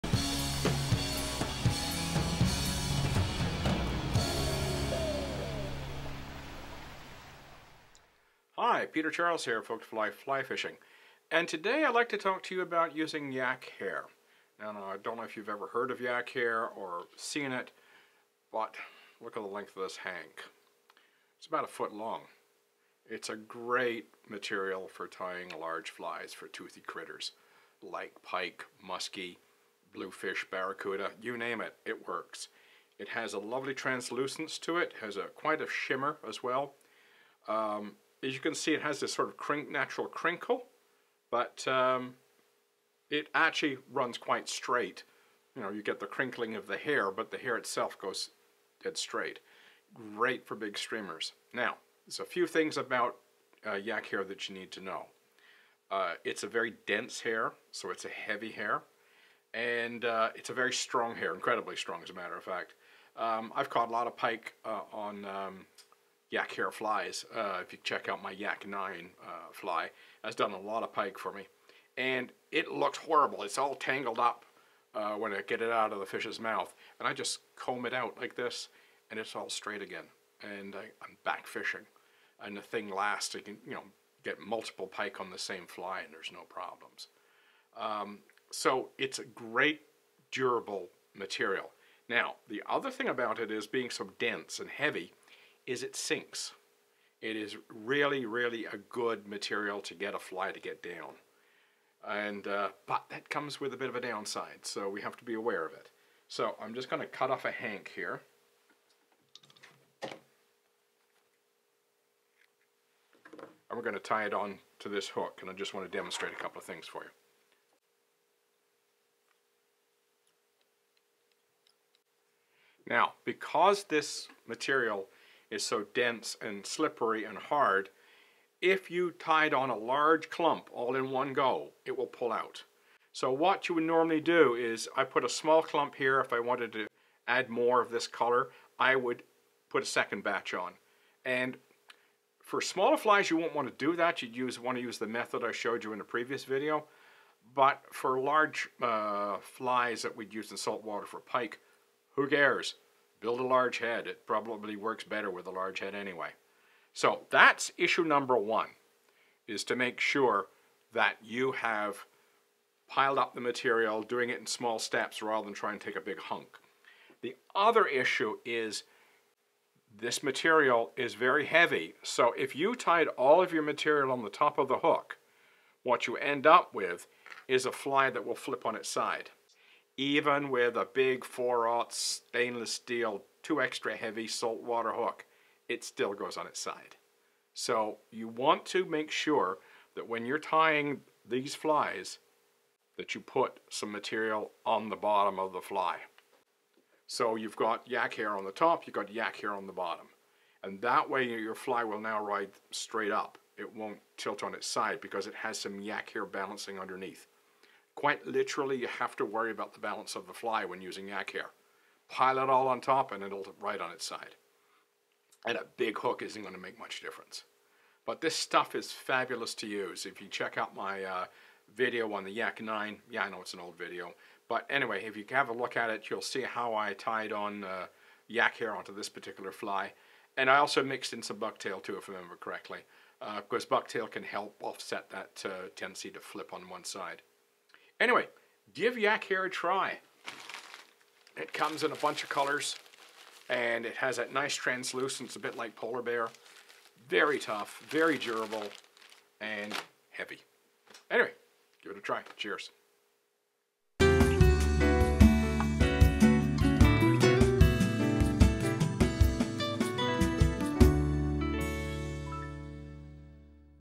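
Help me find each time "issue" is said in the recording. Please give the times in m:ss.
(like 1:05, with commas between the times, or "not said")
2:37, 2:47.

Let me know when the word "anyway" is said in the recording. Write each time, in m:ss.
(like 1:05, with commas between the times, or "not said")
2:35, 3:44, 3:58, 4:11.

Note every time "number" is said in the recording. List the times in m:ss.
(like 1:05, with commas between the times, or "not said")
2:38.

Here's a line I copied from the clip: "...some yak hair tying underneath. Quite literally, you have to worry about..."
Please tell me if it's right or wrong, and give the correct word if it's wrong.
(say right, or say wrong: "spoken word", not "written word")
wrong: "balancing", not "tying".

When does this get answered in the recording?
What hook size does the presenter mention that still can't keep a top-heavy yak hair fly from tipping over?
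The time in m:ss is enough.
3:01.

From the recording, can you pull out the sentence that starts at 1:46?
So I'm just going to cut off a hank here.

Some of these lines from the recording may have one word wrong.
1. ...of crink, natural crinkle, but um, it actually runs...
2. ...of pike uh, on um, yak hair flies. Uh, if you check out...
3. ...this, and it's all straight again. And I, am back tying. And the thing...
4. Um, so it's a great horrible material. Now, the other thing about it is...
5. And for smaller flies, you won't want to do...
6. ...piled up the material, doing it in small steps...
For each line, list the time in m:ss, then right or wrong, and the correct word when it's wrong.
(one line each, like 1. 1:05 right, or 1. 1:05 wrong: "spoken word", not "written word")
1. 0:39 right
2. 1:04 right
3. 1:18 wrong: "fishing", not "tying"
4. 1:27 wrong: "durable", not "horrible"
5. 2:21 right
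6. 2:42 right.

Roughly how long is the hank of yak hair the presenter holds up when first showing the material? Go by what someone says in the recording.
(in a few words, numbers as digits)
1 foot.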